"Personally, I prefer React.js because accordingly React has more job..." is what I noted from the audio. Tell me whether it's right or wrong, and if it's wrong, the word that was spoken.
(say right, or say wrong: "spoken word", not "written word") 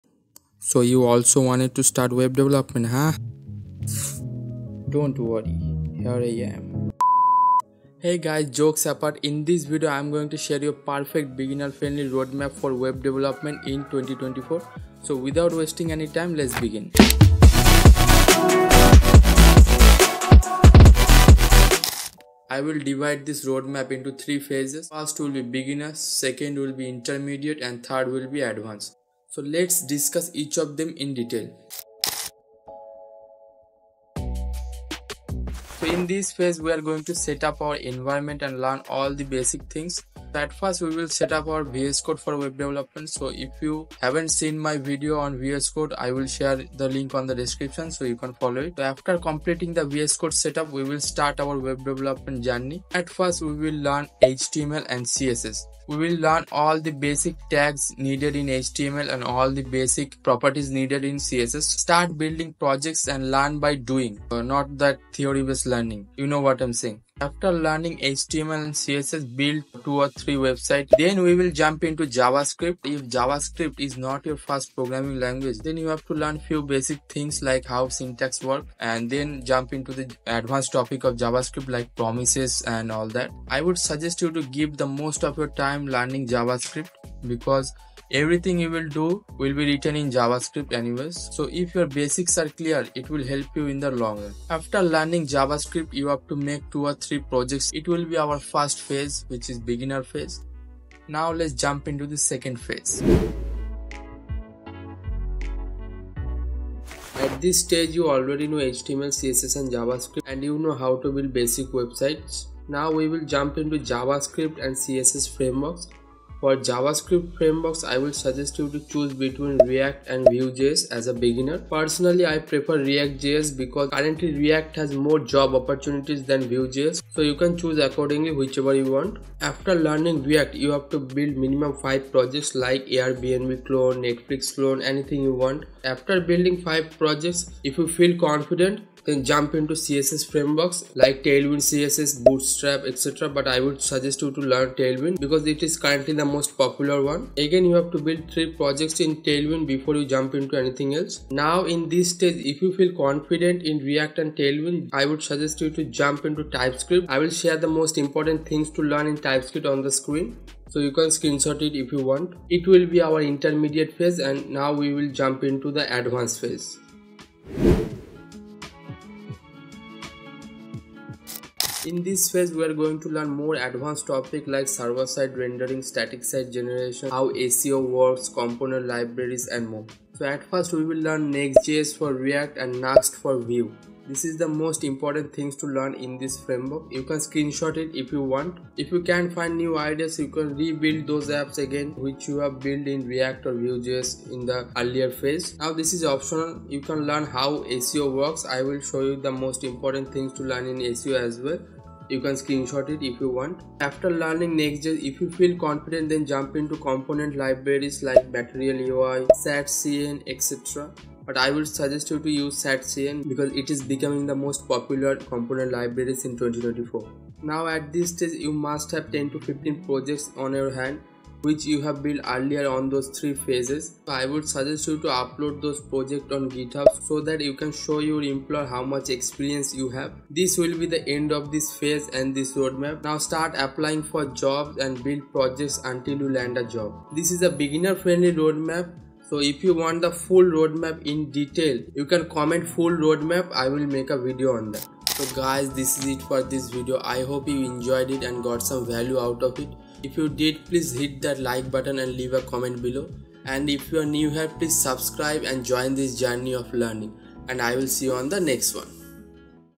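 wrong: "currently", not "accordingly".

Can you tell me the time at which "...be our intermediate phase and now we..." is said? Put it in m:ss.
2:42.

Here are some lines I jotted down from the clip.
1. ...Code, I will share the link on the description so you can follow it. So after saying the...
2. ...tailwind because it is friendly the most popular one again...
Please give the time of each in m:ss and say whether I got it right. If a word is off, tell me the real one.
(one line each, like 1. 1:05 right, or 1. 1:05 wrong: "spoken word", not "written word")
1. 0:45 wrong: "completing", not "saying"
2. 2:24 wrong: "currently", not "friendly".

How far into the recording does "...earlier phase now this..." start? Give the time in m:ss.
3:14.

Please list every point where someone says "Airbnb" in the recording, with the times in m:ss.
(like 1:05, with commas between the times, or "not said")
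2:12.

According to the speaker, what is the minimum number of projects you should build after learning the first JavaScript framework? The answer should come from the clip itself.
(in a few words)
5.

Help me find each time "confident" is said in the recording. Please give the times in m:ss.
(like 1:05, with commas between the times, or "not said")
2:18, 2:33, 3:25.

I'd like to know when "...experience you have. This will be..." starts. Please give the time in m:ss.
3:49.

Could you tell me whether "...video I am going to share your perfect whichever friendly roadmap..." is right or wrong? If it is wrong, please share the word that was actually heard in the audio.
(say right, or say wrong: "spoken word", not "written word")
wrong: "beginner", not "whichever".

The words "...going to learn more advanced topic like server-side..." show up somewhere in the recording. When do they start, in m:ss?
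2:52.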